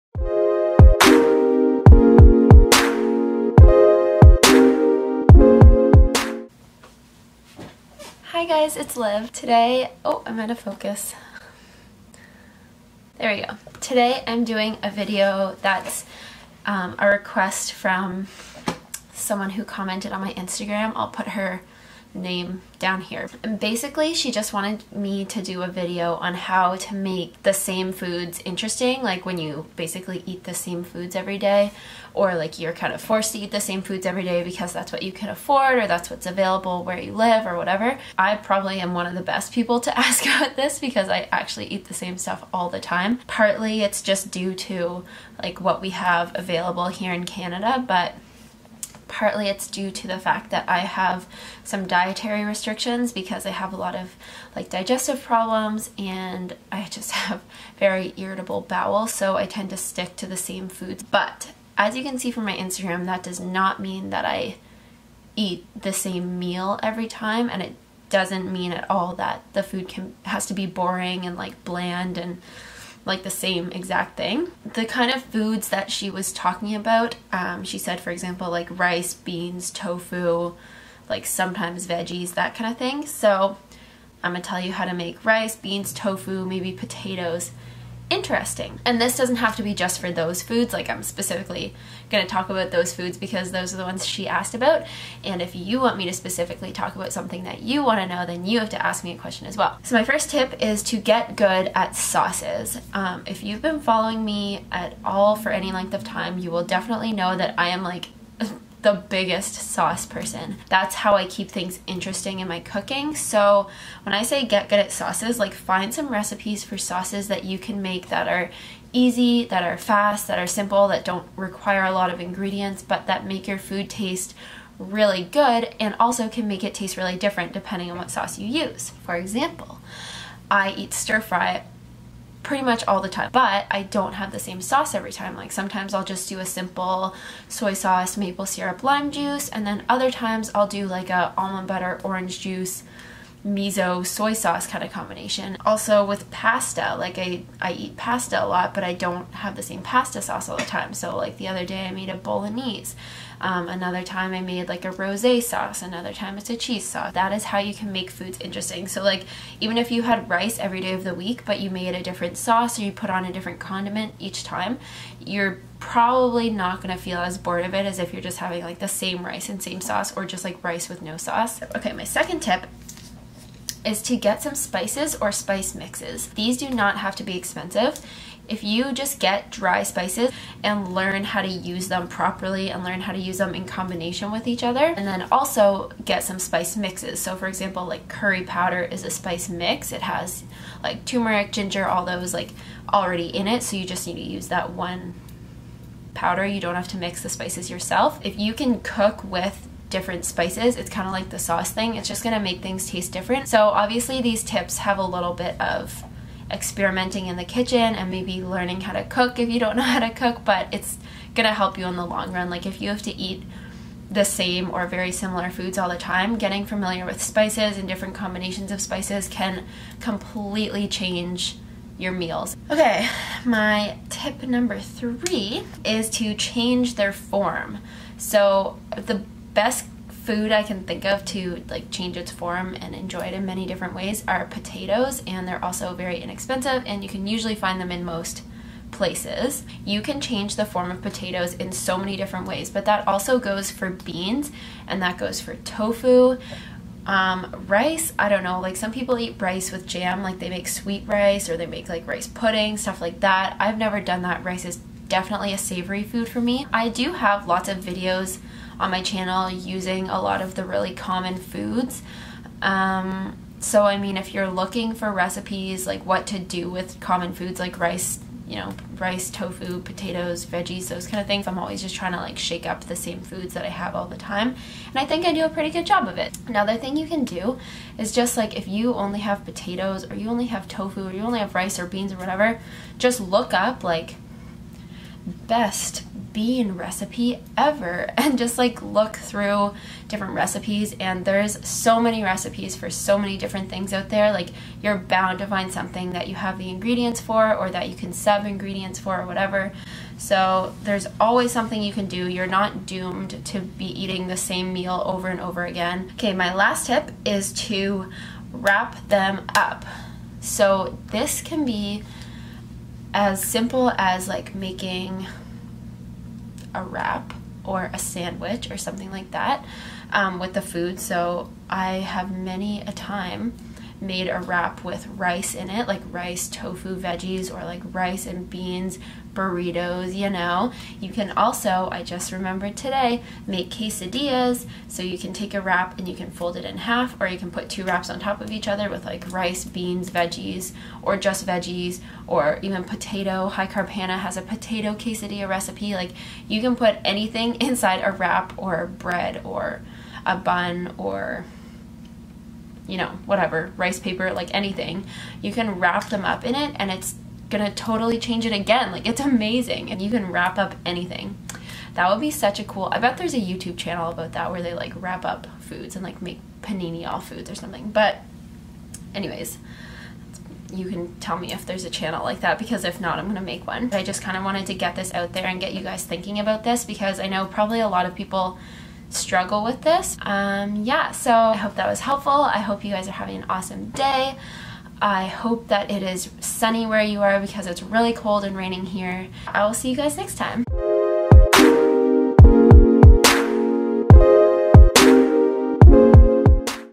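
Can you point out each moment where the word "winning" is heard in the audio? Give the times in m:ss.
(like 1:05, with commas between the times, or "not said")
not said.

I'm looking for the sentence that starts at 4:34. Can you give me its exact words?
And I think I do a pretty good job of it.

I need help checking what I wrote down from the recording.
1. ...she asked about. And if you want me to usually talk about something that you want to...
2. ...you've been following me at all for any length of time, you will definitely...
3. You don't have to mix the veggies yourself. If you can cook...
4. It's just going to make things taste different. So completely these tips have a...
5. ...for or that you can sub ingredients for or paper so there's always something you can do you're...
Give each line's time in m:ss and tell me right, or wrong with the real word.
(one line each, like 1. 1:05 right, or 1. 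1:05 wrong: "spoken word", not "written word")
1. 1:34 wrong: "specifically", not "usually"
2. 1:43 right
3. 3:16 wrong: "spices", not "veggies"
4. 3:21 wrong: "obviously", not "completely"
5. 4:57 wrong: "whatever", not "paper".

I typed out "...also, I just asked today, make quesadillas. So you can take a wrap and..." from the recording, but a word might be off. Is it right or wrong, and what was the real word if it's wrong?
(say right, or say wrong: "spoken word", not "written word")
wrong: "remembered", not "asked".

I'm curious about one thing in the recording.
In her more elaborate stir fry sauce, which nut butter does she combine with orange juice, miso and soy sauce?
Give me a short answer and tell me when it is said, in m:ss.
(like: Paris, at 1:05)
almond butter, at 2:21.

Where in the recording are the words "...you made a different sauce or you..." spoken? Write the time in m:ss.
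2:41.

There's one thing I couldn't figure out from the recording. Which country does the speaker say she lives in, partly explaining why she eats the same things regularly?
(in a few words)
Canada.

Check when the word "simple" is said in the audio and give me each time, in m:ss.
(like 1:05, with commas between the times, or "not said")
2:00, 2:16, 5:13.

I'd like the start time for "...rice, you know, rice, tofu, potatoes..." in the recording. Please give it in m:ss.
4:27.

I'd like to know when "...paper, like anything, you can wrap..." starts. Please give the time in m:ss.
5:53.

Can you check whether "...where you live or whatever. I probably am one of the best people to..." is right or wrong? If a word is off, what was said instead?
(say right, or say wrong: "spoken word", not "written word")
right.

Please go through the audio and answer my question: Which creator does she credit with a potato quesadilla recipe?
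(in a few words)
High Carb Hannah.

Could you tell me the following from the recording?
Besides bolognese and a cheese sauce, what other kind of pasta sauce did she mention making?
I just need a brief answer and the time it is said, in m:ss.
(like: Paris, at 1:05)
rosé sauce, at 2:34.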